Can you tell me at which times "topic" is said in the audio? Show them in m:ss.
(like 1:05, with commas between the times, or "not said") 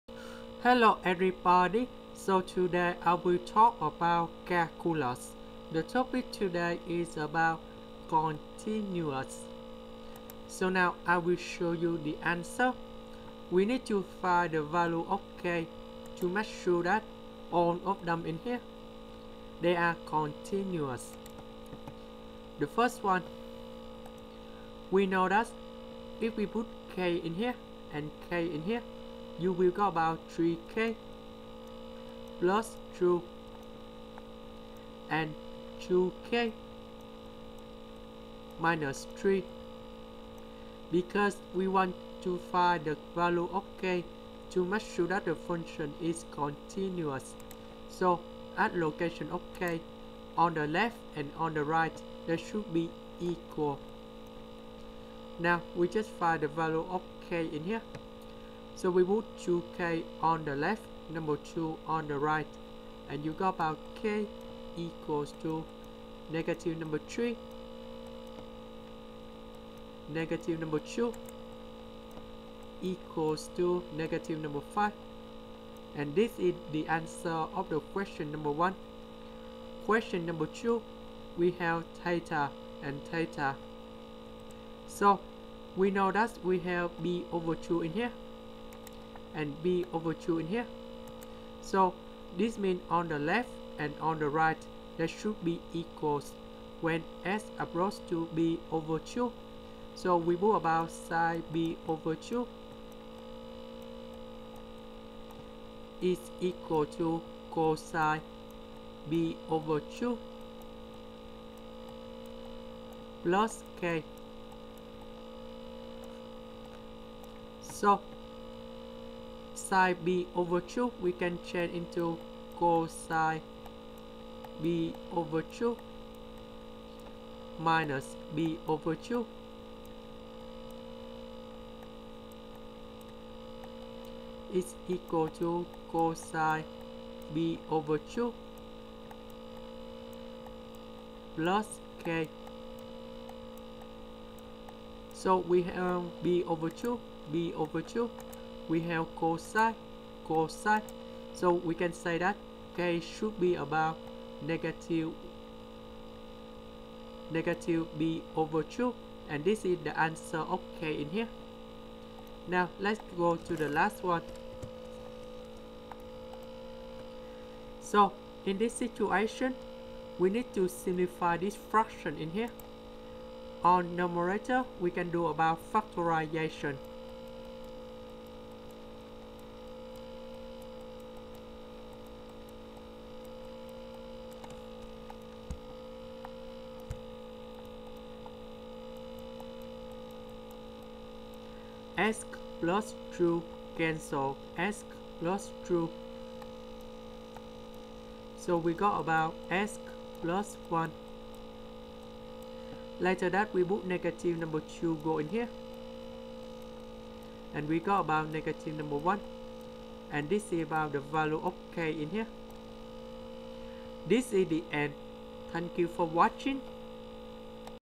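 0:05.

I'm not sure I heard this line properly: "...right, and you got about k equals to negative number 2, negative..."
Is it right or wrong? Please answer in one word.
wrong.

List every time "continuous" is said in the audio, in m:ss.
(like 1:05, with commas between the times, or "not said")
0:08, 0:20, 0:46.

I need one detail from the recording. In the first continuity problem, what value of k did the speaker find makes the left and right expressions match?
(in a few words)
-5.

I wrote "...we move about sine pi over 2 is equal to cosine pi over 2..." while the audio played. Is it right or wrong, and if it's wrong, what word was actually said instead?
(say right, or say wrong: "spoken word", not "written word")
right.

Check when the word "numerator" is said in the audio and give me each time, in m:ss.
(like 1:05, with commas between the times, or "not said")
2:53.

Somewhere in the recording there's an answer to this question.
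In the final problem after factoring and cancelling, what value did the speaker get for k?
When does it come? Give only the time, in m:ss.
3:28.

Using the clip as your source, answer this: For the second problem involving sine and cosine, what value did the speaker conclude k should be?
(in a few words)
-pi/2.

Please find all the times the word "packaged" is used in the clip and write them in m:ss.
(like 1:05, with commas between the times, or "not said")
not said.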